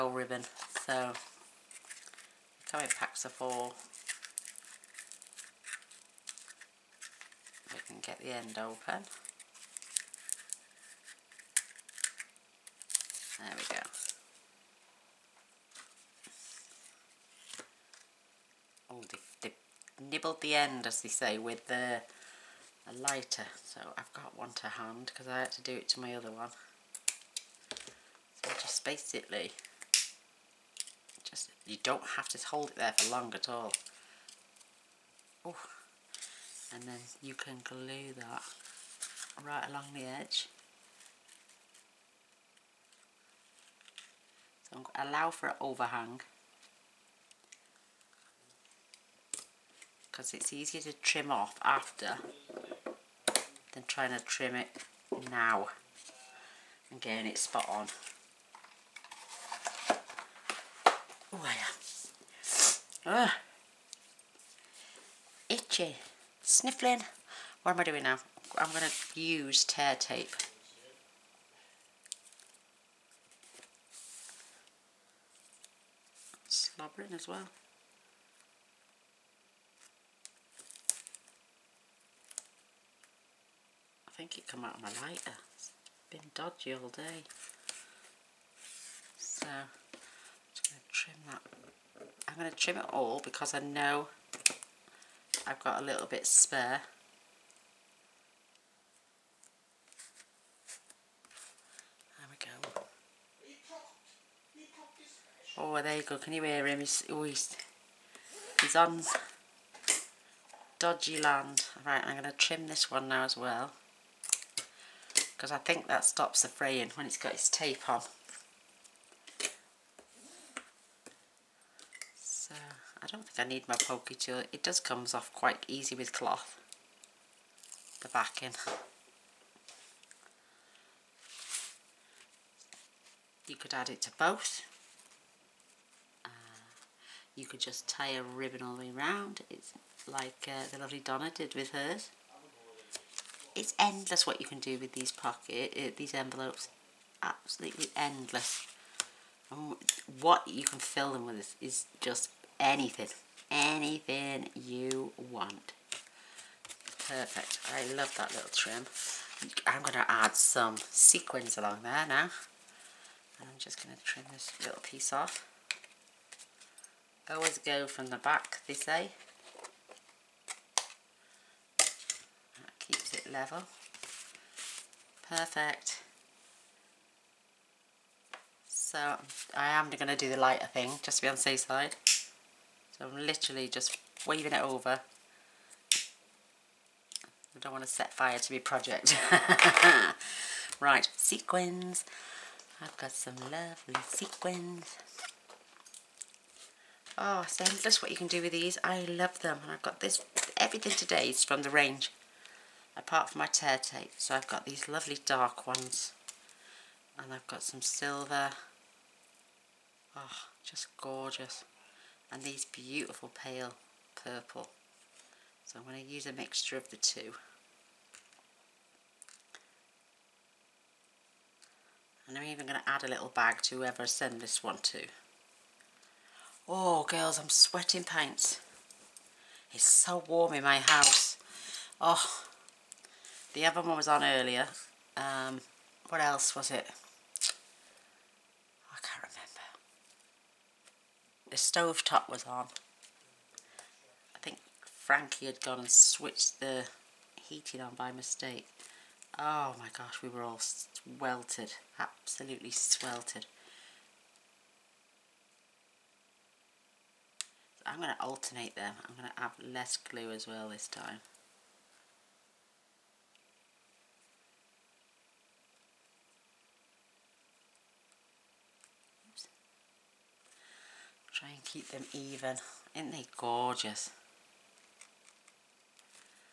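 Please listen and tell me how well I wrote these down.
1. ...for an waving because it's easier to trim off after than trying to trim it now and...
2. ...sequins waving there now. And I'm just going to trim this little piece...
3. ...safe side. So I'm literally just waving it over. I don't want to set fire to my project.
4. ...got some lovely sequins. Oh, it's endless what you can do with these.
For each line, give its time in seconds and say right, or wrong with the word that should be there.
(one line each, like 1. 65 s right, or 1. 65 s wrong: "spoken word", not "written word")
1. 45 s wrong: "overhang", not "waving"
2. 160 s wrong: "along", not "waving"
3. 181 s right
4. 192 s right.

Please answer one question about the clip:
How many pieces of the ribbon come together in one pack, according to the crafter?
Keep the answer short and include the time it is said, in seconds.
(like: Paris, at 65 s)
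4, at 3 s.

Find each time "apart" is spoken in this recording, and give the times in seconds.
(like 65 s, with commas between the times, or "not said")
202 s.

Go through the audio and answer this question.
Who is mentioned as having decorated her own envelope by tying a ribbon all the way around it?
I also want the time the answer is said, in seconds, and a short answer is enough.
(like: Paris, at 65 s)
Donna, at 140 s.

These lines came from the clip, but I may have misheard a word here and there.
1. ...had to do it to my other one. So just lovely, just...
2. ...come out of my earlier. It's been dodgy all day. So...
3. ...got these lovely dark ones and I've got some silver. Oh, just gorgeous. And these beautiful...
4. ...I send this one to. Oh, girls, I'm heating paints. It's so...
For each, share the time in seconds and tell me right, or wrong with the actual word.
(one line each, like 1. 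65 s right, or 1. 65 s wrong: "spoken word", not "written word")
1. 25 s wrong: "basically", not "lovely"
2. 84 s wrong: "lighter", not "earlier"
3. 204 s right
4. 224 s wrong: "sweating", not "heating".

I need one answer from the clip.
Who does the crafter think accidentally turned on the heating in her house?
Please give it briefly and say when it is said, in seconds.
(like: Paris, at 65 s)
Frankie, at 244 s.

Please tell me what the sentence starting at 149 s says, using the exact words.
And what you can fill them with is just anything, anything you want.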